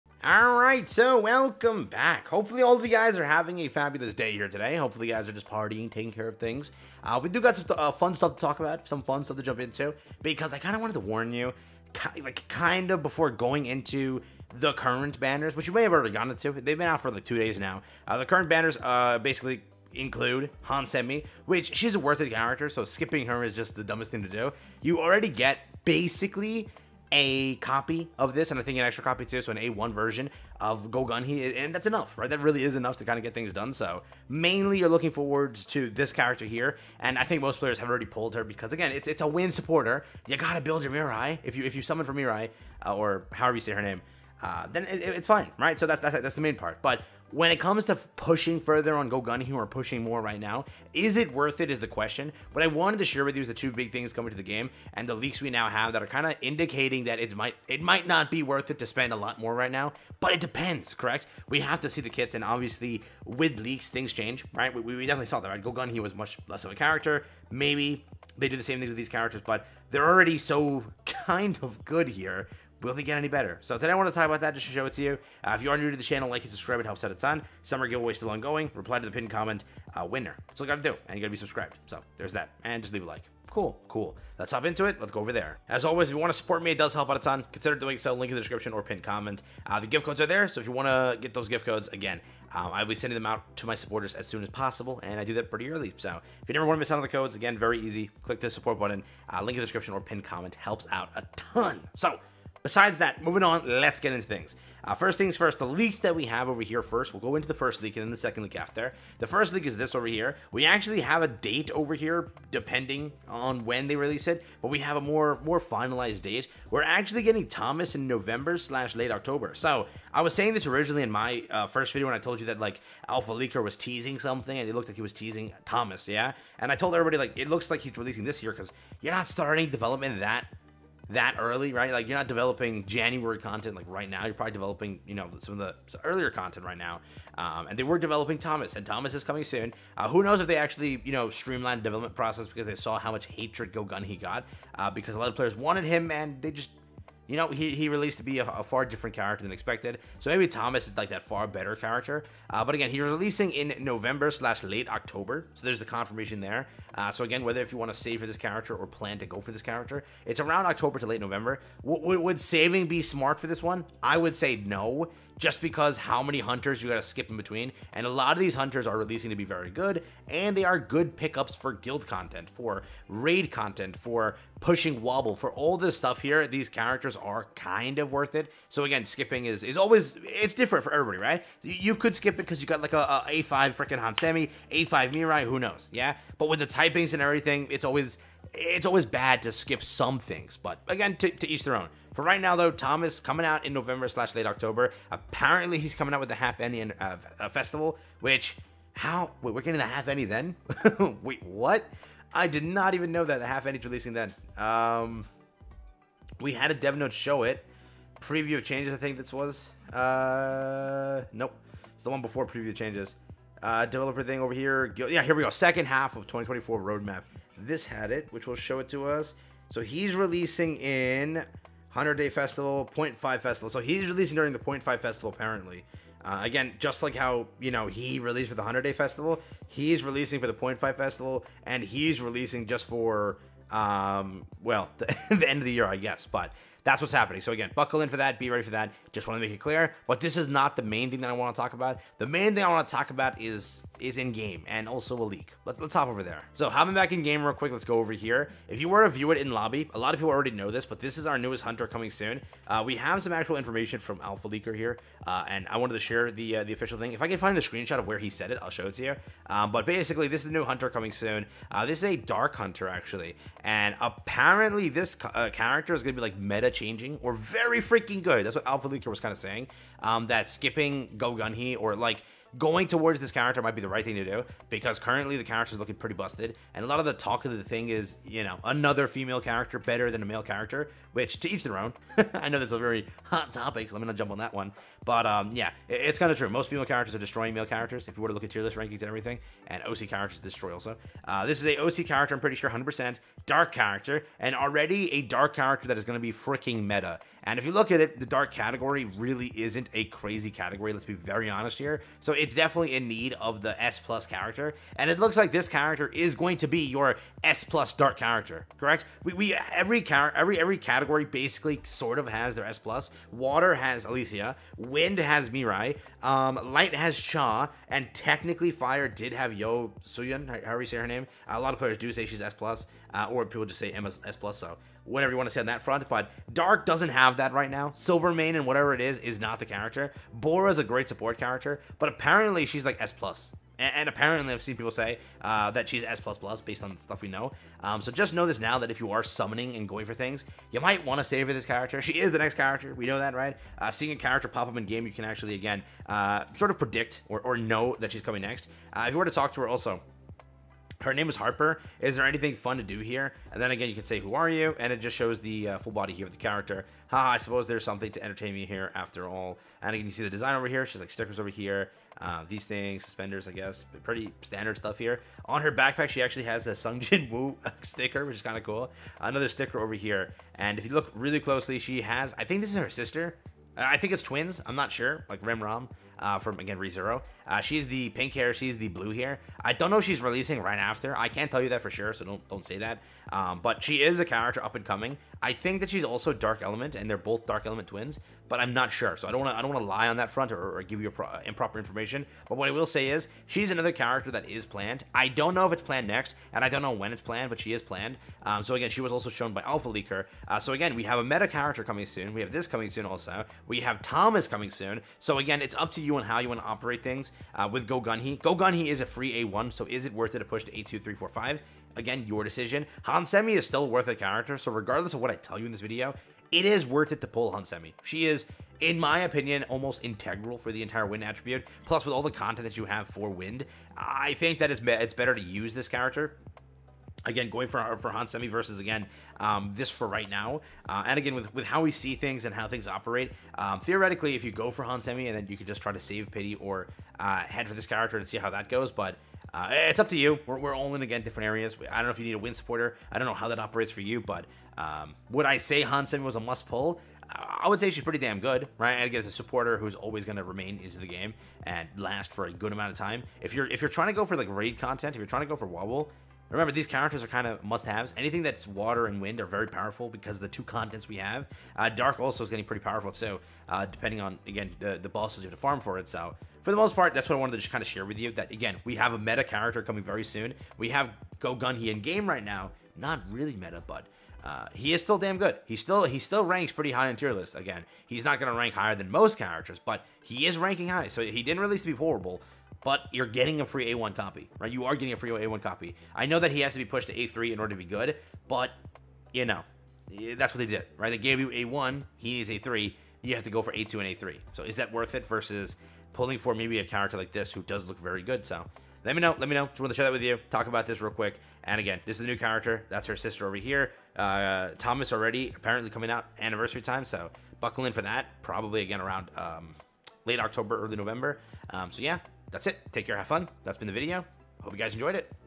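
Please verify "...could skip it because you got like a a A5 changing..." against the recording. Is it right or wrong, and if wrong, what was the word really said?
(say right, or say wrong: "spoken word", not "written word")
wrong: "freaking", not "changing".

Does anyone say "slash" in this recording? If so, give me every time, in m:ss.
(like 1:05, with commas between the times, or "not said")
1:58, 2:34, 3:14.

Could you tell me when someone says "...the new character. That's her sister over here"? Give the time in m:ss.
8:22.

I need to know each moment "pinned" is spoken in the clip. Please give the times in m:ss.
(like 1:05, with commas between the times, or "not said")
1:19, 1:28, 1:40.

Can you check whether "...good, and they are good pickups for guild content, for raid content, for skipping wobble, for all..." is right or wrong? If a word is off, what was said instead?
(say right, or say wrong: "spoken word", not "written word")
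wrong: "pushing", not "skipping".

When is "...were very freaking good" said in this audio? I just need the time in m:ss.
4:27.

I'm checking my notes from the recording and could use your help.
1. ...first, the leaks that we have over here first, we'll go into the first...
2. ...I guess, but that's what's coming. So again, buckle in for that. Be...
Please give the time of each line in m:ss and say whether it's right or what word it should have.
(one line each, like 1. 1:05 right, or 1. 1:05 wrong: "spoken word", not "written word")
1. 1:45 right
2. 3:55 wrong: "happening", not "coming".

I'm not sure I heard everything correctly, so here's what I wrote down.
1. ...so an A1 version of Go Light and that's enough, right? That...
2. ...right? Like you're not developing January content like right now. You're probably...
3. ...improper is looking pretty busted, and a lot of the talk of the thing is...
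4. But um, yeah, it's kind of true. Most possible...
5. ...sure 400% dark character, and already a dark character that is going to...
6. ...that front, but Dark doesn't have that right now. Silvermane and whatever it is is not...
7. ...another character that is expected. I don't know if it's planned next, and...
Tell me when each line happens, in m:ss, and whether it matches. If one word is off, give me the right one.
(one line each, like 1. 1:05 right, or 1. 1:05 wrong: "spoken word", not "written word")
1. 0:29 wrong: "Gunhee", not "Light"
2. 2:11 right
3. 4:35 wrong: "character", not "improper"
4. 4:45 wrong: "female", not "possible"
5. 4:52 wrong: "100", not "400"
6. 5:25 right
7. 6:33 wrong: "planned", not "expected".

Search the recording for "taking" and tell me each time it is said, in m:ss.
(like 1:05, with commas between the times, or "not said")
0:05.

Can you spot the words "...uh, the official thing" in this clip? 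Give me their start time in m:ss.
4:16.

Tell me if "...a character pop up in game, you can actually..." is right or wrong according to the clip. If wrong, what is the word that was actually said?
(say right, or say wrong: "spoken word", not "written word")
right.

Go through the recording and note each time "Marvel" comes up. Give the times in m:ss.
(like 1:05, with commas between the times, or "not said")
not said.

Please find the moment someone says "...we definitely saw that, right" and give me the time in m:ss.
1:04.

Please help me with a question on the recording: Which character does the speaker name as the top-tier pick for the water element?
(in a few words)
Alicia.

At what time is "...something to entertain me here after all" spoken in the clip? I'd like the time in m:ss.
5:57.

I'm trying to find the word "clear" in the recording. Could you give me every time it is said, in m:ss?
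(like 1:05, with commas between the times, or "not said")
3:59.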